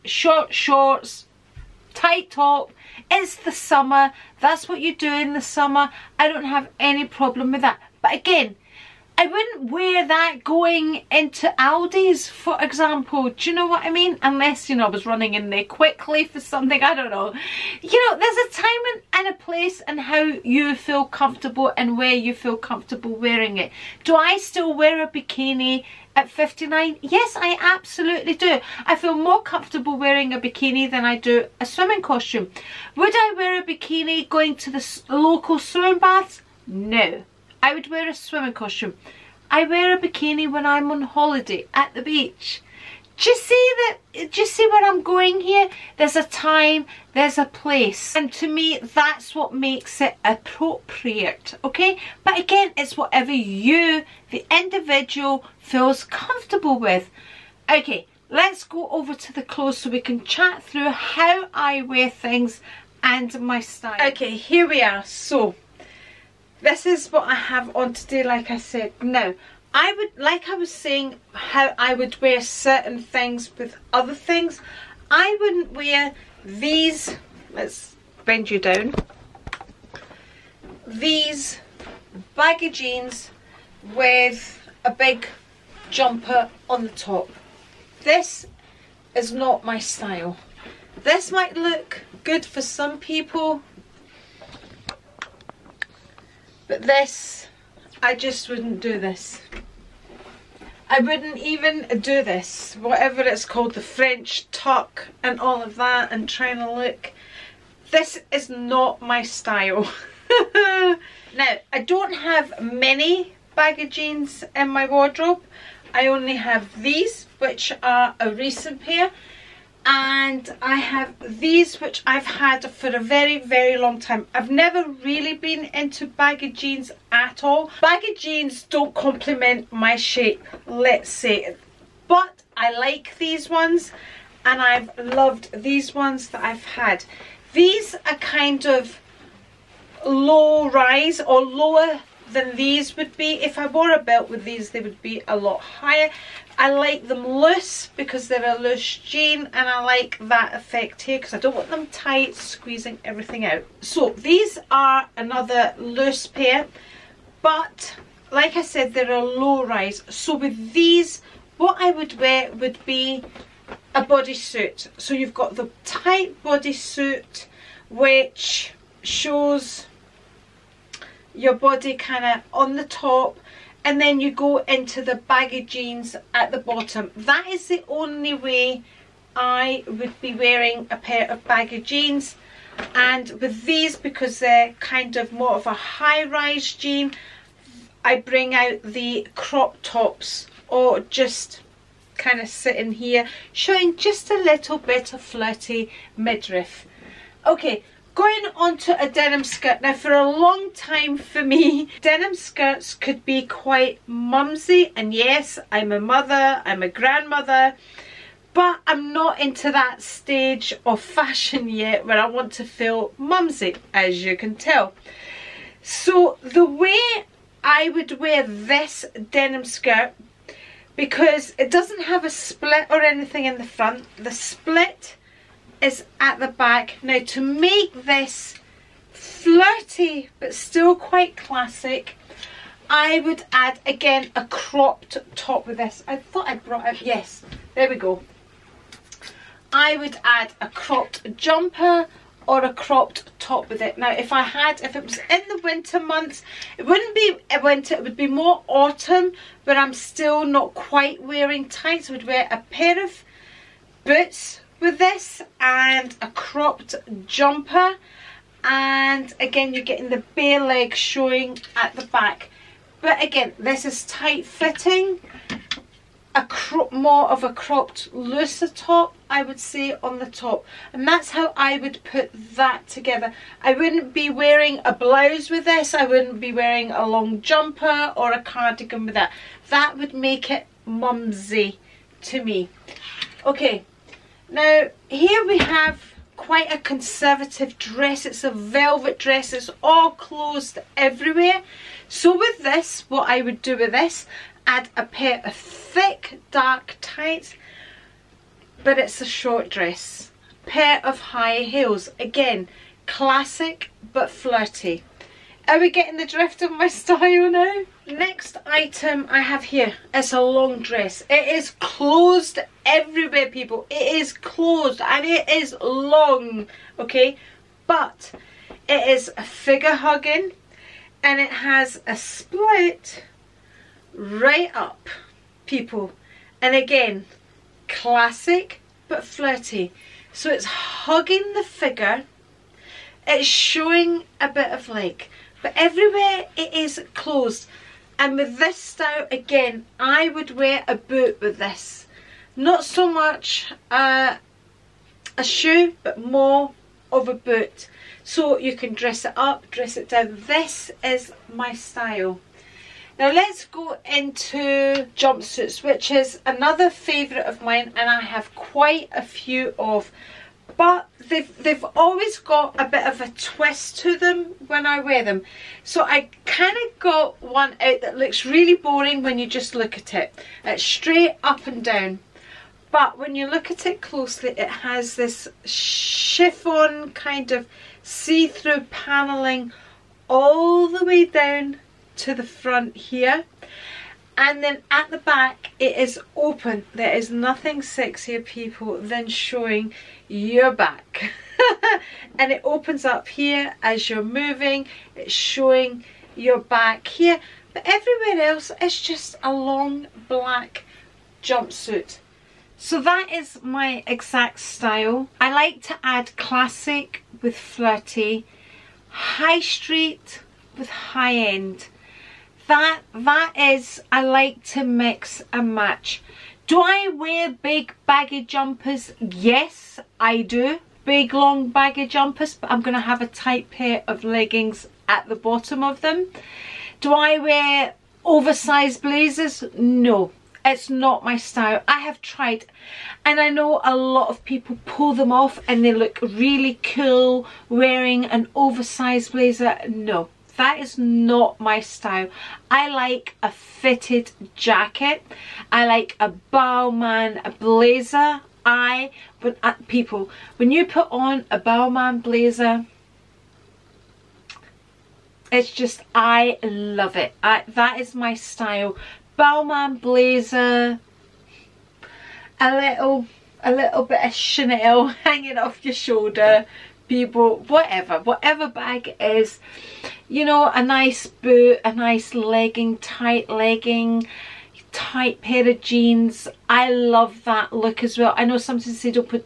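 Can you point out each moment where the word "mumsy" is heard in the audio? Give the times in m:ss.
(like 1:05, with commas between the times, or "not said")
3:24, 3:33, 4:40.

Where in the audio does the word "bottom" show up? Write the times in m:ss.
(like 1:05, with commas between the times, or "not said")
2:56, 7:05.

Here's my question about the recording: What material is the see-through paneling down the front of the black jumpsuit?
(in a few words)
Chiffon.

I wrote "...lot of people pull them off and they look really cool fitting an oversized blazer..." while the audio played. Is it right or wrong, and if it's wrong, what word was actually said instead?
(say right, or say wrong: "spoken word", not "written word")
wrong: "wearing", not "fitting".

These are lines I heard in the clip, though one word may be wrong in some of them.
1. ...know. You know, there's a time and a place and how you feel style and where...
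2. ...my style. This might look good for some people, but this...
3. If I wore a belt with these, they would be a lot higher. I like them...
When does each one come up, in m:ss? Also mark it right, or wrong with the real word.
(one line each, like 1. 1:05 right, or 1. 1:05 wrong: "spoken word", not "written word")
1. 0:17 wrong: "comfortable", not "style"
2. 1:29 right
3. 2:23 right.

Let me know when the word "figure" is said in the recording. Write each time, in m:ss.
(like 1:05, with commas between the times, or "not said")
5:19, 5:31.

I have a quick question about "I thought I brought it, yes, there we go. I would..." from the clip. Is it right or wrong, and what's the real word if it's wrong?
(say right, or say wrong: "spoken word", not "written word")
right.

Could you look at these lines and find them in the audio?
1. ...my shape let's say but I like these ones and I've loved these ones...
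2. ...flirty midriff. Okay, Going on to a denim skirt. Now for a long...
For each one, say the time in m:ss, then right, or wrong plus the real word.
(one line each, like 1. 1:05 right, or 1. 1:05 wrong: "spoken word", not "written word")
1. 2:09 right
2. 3:15 right.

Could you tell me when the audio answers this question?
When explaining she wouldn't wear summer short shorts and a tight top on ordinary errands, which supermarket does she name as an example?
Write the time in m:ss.
0:11.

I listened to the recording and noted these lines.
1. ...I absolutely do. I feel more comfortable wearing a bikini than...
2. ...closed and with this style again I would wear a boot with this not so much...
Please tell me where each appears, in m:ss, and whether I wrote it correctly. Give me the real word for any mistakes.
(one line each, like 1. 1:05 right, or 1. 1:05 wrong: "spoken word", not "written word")
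1. 0:27 right
2. 5:37 right.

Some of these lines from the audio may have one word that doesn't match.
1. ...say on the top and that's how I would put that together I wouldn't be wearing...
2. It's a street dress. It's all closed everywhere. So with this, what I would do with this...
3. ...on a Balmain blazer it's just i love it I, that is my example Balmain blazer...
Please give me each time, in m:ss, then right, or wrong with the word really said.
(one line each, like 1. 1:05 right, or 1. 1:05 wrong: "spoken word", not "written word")
1. 4:29 right
2. 4:48 wrong: "velvet", not "street"
3. 7:31 wrong: "style", not "example".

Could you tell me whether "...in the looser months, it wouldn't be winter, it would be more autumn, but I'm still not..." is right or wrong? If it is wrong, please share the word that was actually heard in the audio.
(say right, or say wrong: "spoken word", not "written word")
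wrong: "winter", not "looser".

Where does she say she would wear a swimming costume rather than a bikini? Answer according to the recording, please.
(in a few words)
local swimming baths.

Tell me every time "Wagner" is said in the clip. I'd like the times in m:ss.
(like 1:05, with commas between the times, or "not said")
not said.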